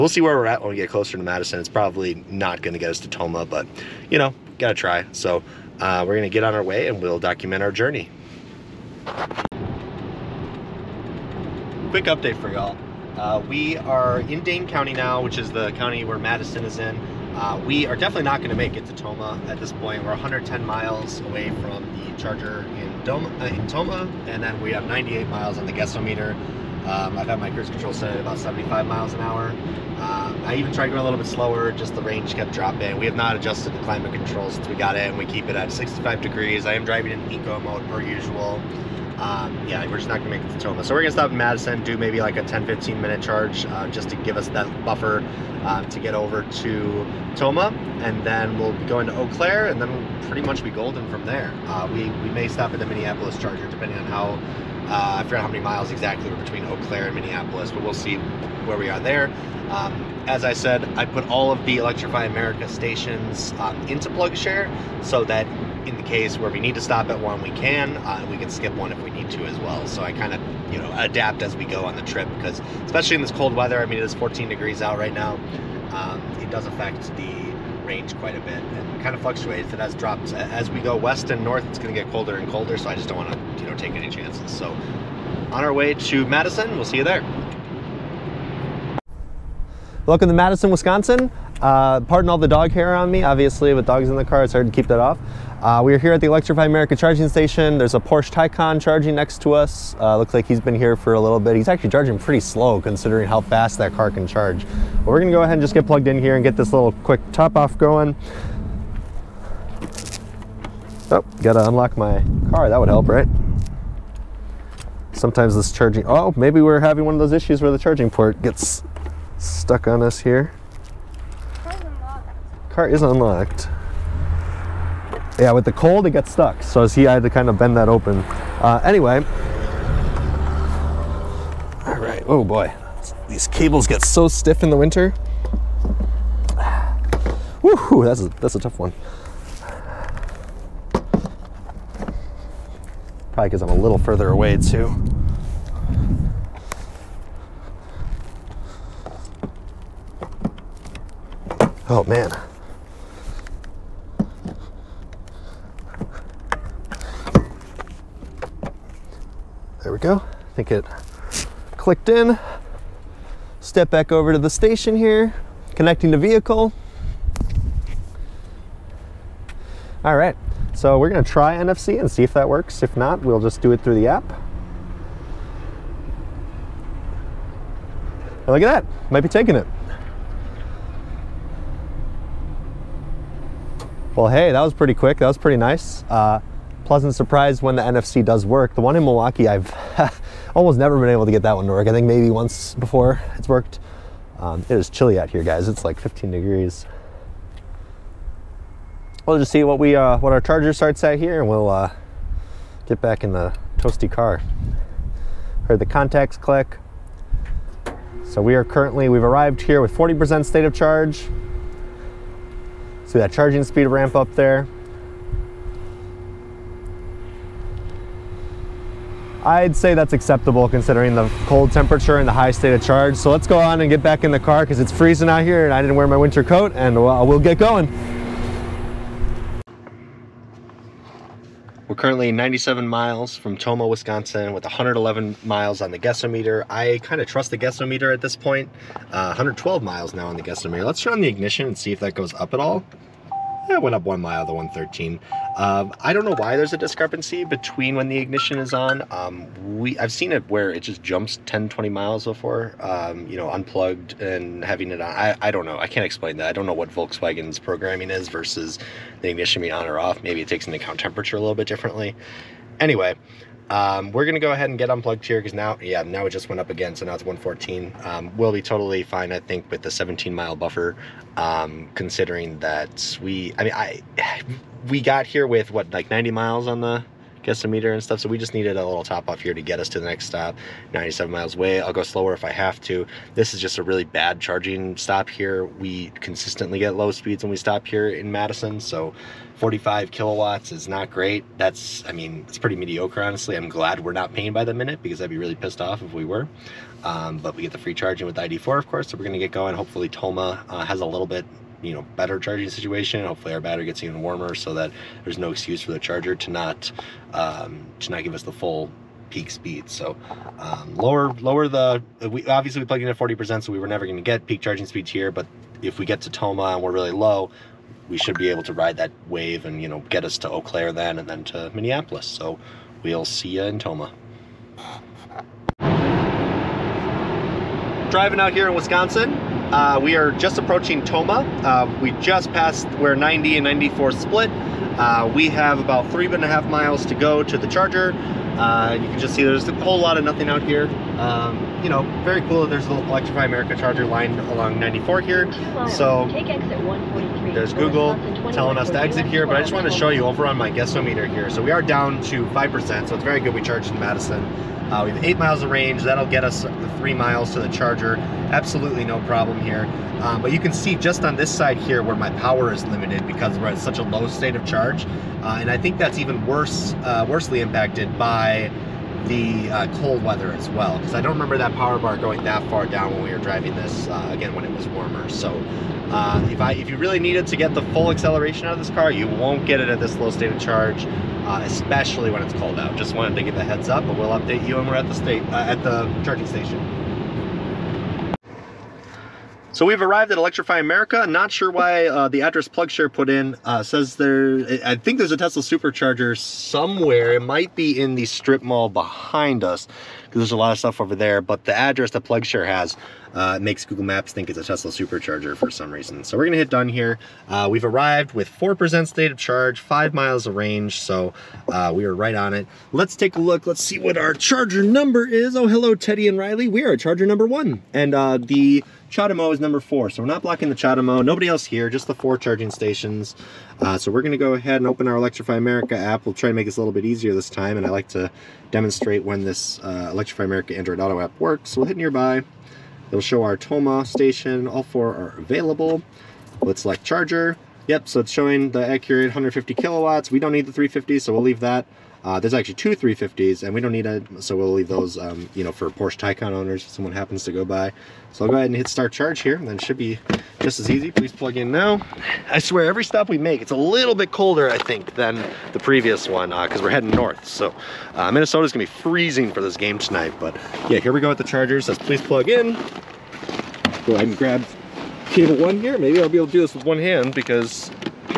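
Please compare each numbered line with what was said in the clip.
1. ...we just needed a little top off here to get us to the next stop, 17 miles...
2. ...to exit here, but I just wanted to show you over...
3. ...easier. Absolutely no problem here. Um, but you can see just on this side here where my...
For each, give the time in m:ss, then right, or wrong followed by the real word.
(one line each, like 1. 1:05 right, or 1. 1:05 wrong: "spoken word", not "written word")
1. 4:38 wrong: "97", not "17"
2. 5:48 right
3. 5:57 wrong: "charger", not "easier".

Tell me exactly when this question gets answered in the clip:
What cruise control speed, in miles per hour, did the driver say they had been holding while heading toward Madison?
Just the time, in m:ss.
0:28.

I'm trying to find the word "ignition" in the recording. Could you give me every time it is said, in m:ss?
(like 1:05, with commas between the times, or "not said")
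4:01, 4:08, 4:19.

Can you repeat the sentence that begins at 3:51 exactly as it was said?
We're currently 97 miles from Tomah, Wisconsin with 111 miles on the Guessometer.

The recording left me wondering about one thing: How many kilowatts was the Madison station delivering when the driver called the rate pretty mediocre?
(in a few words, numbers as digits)
45 kilowatts.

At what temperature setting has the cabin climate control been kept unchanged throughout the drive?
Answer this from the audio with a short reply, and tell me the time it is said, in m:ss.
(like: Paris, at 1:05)
65 degrees, at 0:35.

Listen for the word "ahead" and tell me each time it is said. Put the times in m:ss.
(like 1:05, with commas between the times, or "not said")
1:45, 4:24, 7:04, 7:28, 7:44.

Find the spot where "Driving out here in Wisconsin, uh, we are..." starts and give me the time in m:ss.
5:28.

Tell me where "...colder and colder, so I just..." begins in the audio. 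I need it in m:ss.
1:22.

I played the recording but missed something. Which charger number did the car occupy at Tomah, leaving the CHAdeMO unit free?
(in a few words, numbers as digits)
1.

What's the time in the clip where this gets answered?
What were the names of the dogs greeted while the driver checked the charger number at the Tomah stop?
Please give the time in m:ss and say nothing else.
6:55.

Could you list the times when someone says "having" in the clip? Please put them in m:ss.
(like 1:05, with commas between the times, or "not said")
1:56, 4:14.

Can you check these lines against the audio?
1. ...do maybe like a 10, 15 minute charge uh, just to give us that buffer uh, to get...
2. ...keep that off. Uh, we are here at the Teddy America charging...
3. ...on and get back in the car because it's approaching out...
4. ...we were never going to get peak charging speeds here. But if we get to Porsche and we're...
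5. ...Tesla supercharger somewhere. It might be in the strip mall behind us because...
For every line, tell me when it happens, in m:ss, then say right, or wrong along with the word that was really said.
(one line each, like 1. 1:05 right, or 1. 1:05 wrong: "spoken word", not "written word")
1. 0:41 right
2. 1:34 wrong: "Electrify", not "Teddy"
3. 3:43 wrong: "freezing", not "approaching"
4. 5:13 wrong: "Tomah", not "Porsche"
5. 6:35 right.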